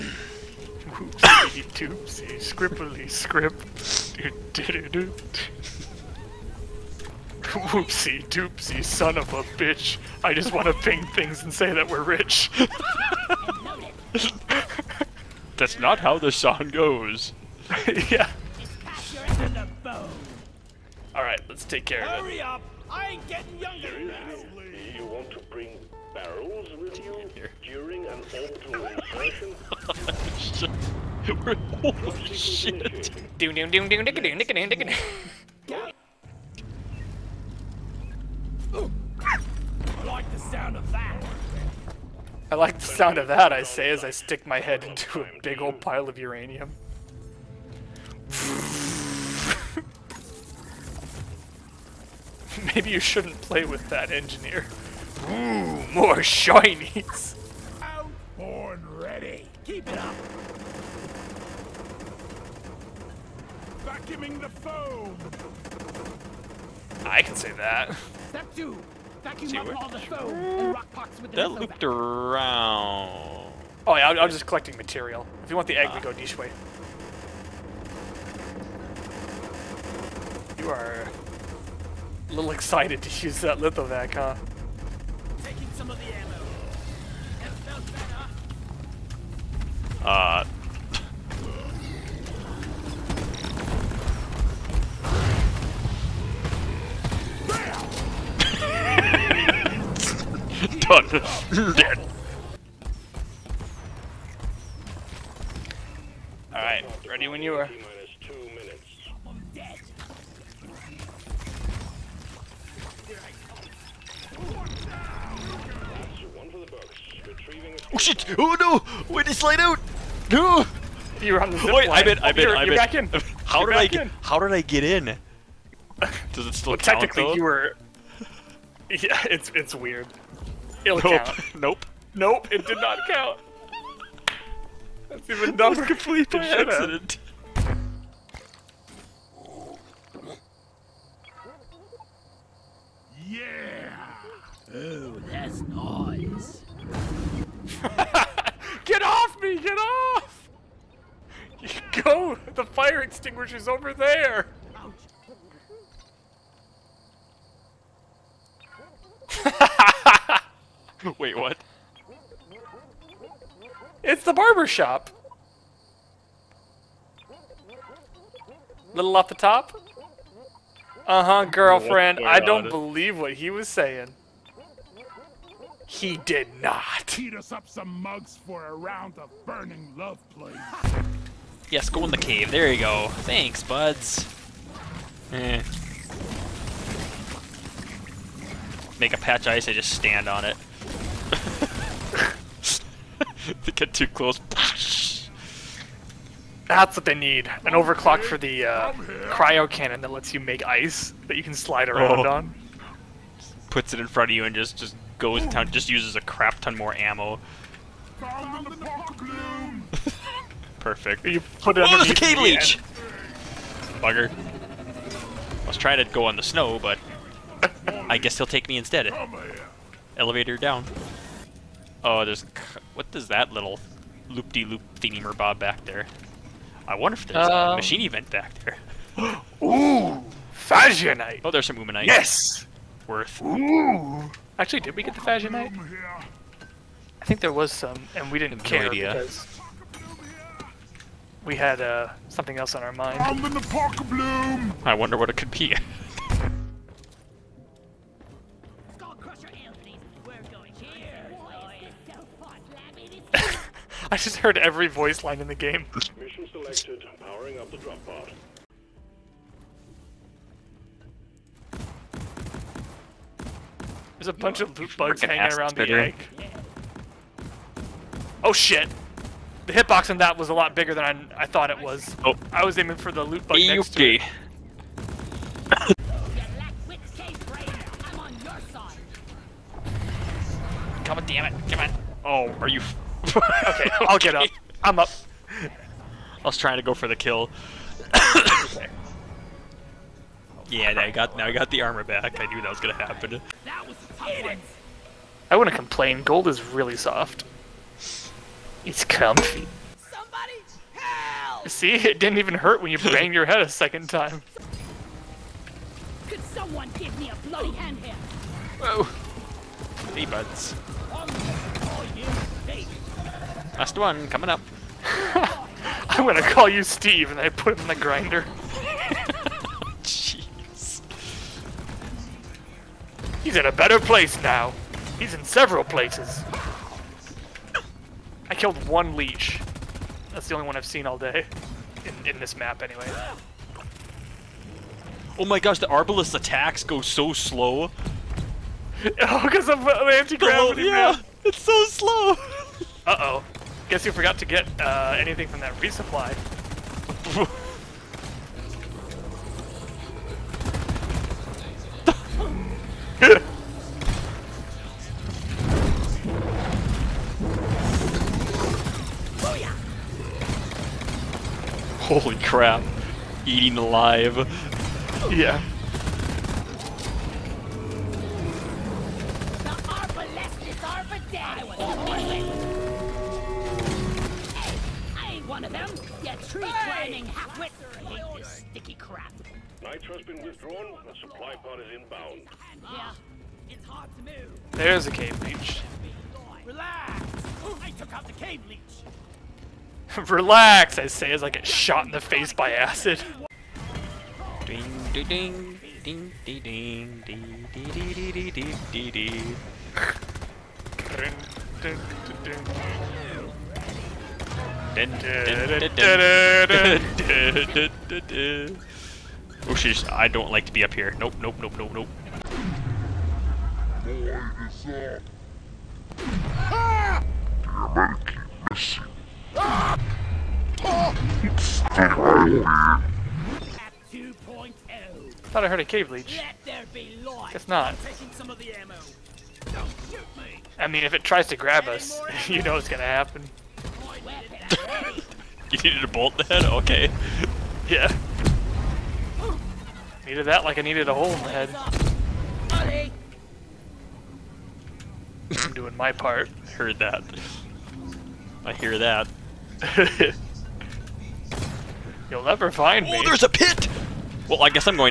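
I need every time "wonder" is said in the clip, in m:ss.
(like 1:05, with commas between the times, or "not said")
3:46, 4:04.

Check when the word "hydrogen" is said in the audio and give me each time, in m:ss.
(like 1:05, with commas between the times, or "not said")
not said.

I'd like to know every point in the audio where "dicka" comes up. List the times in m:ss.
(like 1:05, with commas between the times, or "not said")
0:34.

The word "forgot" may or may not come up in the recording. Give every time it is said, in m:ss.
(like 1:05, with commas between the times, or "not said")
5:44.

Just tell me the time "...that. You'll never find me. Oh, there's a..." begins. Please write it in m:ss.
7:28.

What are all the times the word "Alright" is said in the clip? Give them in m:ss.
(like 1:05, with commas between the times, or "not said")
0:21, 1:46.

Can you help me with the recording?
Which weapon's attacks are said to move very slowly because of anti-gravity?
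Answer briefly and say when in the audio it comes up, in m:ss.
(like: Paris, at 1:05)
Arbalest, at 5:35.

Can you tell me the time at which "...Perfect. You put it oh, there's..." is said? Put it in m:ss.
3:30.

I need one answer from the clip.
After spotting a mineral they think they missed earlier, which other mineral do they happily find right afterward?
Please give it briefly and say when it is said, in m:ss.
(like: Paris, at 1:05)
Umanite, at 3:51.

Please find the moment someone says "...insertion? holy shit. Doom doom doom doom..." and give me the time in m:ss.
0:28.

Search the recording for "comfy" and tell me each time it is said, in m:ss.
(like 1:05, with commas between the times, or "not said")
4:59.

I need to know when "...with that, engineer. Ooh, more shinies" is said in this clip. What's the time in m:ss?
0:53.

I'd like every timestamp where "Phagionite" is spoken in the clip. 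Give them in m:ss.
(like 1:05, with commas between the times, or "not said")
3:50, 3:55.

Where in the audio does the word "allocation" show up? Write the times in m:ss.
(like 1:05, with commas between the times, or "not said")
not said.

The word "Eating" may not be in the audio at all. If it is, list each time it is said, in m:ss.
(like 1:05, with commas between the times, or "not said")
6:03.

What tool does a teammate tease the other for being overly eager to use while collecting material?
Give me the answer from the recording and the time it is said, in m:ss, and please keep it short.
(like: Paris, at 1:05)
lithovac, at 1:23.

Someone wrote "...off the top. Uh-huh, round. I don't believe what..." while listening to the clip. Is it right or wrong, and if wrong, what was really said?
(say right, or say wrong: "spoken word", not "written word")
wrong: "girlfriend", not "round".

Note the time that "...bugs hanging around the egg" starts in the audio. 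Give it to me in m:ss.
4:24.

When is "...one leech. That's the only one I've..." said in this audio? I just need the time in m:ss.
5:28.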